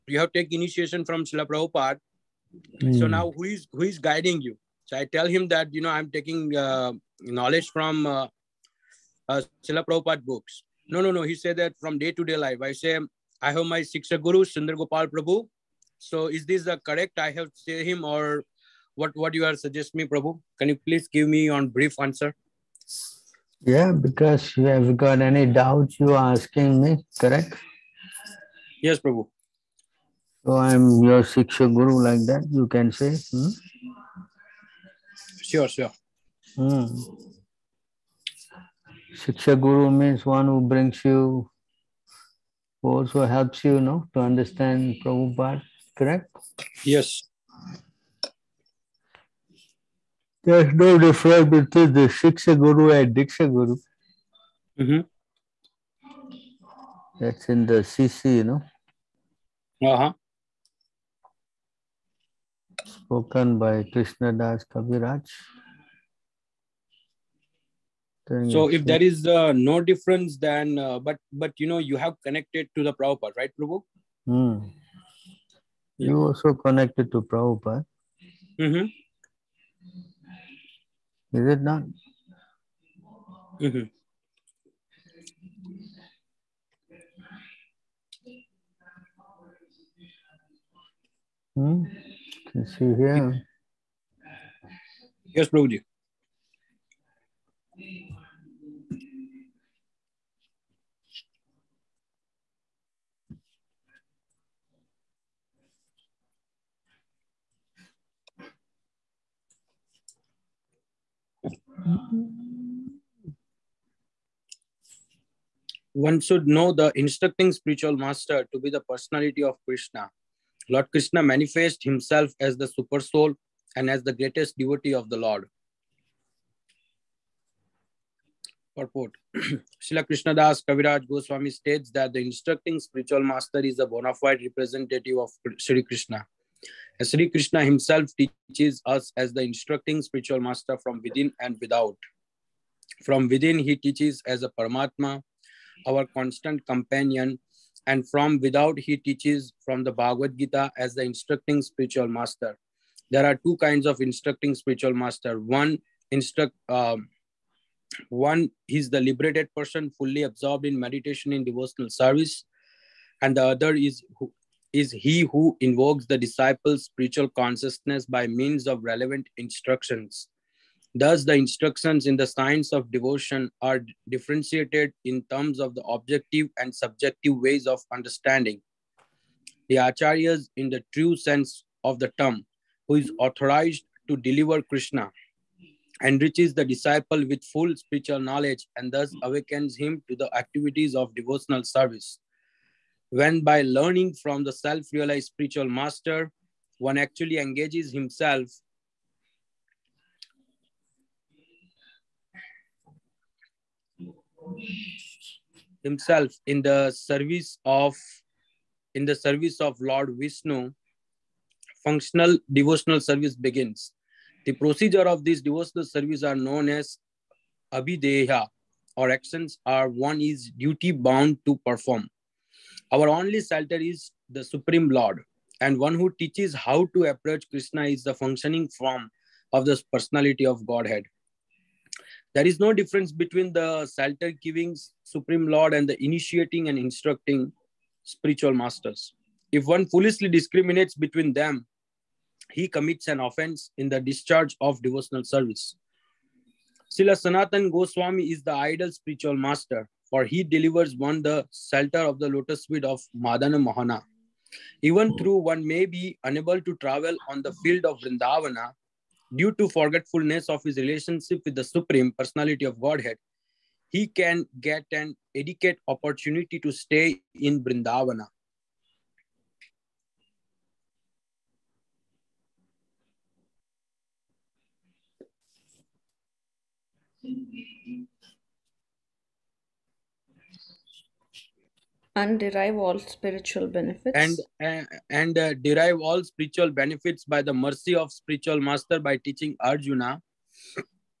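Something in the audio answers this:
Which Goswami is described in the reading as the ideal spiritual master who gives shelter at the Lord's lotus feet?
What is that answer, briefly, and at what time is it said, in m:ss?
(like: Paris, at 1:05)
Sanatan Goswami, at 4:07.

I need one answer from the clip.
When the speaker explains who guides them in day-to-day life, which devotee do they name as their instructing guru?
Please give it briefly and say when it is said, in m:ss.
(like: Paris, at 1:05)
Sundar Gopal Prabhu, at 0:14.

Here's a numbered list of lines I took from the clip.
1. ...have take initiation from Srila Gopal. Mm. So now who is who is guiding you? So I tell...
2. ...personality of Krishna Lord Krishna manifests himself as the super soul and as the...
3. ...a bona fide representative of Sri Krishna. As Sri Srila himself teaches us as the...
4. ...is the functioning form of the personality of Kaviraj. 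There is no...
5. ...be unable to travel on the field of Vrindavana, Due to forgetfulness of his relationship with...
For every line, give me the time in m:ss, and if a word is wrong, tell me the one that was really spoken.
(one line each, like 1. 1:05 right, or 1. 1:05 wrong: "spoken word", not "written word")
1. 0:00 wrong: "Prabhupada", not "Gopal"
2. 1:58 right
3. 2:13 wrong: "Krishna", not "Srila"
4. 3:47 wrong: "Godhead", not "Kaviraj"
5. 4:15 right.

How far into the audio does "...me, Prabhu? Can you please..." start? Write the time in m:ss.
0:19.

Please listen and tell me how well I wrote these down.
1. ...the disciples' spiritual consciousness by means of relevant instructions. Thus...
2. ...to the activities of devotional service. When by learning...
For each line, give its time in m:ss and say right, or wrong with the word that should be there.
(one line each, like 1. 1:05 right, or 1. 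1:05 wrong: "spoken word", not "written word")
1. 2:46 right
2. 3:10 right.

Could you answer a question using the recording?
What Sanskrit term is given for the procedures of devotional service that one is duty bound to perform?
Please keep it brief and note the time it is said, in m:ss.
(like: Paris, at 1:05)
abhidheya, at 3:37.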